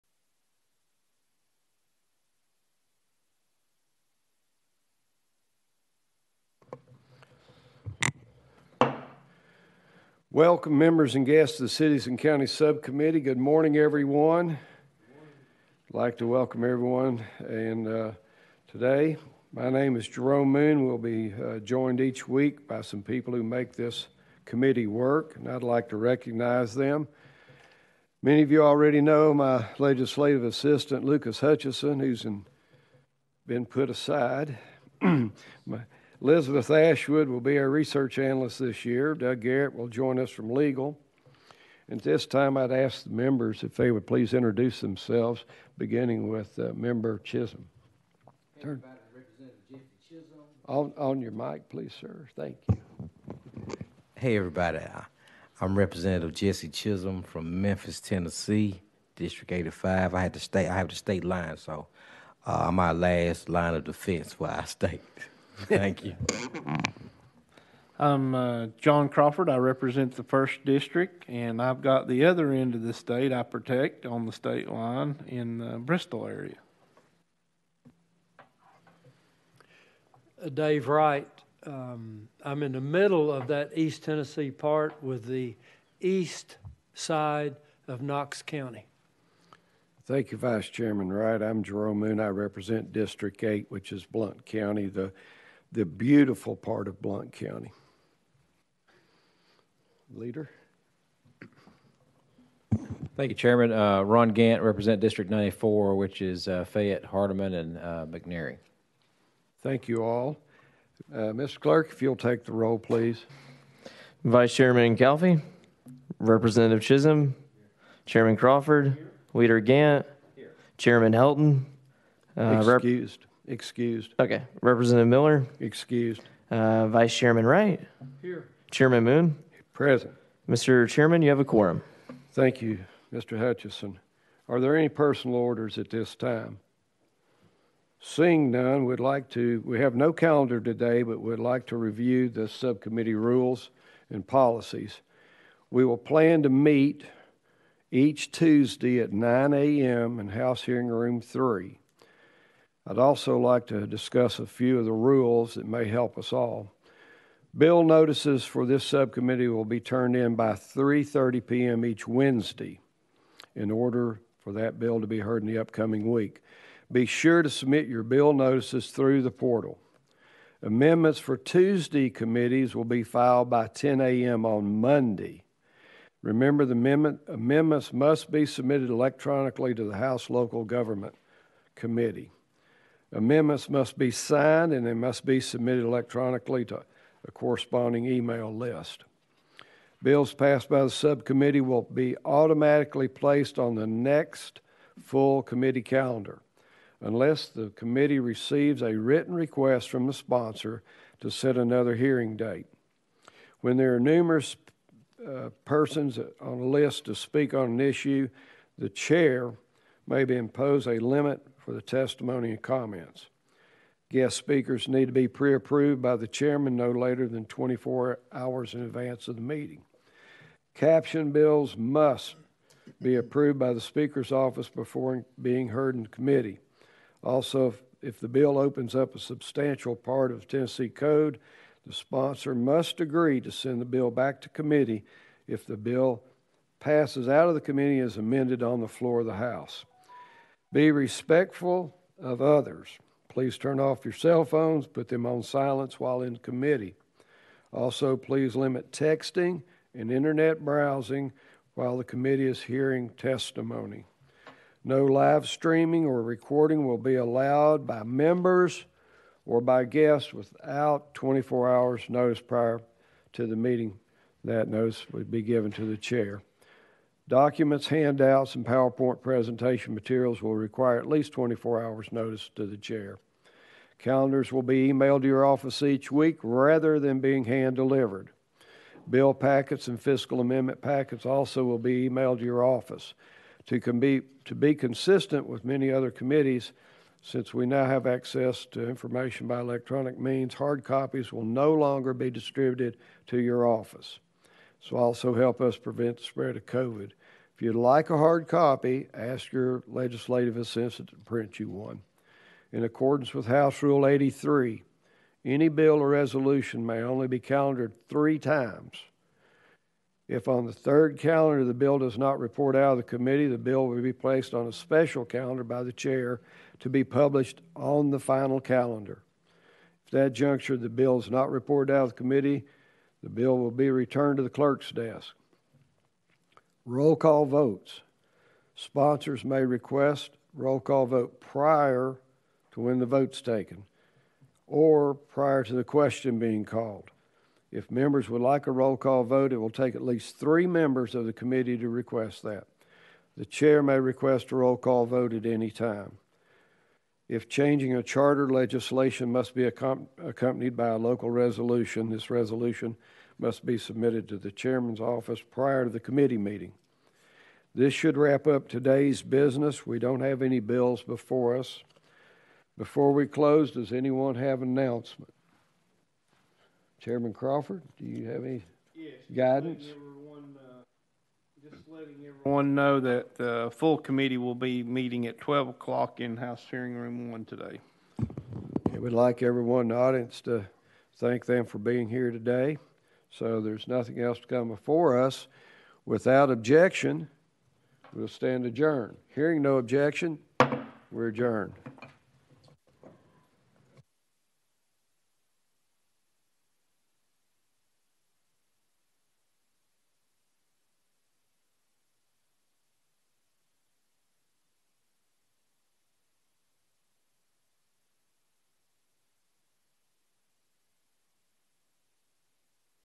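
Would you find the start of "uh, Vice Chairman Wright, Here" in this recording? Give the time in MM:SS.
02:06.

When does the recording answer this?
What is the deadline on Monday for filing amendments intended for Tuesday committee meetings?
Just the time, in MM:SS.
02:53.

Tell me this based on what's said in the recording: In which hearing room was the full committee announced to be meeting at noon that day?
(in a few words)
House Hearing Room 1.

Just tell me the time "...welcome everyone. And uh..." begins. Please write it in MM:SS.
00:16.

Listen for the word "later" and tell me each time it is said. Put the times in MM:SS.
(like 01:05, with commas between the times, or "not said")
03:36.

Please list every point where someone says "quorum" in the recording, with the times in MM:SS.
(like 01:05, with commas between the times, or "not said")
02:11.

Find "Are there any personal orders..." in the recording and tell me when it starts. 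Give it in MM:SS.
02:14.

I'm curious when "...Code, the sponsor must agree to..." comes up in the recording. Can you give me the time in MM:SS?
03:50.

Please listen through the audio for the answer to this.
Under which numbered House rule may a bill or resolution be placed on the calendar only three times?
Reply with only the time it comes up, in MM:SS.
05:03.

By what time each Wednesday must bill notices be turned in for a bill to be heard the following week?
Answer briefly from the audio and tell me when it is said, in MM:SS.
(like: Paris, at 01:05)
3:30 p.m., at 02:40.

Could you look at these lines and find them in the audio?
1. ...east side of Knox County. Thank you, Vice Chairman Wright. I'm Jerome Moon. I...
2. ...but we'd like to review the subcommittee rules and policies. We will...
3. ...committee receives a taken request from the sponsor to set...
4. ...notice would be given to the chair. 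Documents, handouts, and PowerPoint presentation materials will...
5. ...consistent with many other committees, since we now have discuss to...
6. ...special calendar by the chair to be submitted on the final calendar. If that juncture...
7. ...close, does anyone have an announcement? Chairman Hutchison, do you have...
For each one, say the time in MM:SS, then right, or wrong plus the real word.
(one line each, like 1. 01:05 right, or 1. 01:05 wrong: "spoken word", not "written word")
1. 01:25 right
2. 02:21 right
3. 03:17 wrong: "written", not "taken"
4. 04:24 right
5. 04:44 wrong: "access", not "discuss"
6. 05:14 wrong: "published", not "submitted"
7. 06:03 wrong: "Crawford", not "Hutchison".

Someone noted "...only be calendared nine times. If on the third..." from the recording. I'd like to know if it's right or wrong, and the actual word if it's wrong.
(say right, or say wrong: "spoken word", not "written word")
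wrong: "three", not "nine".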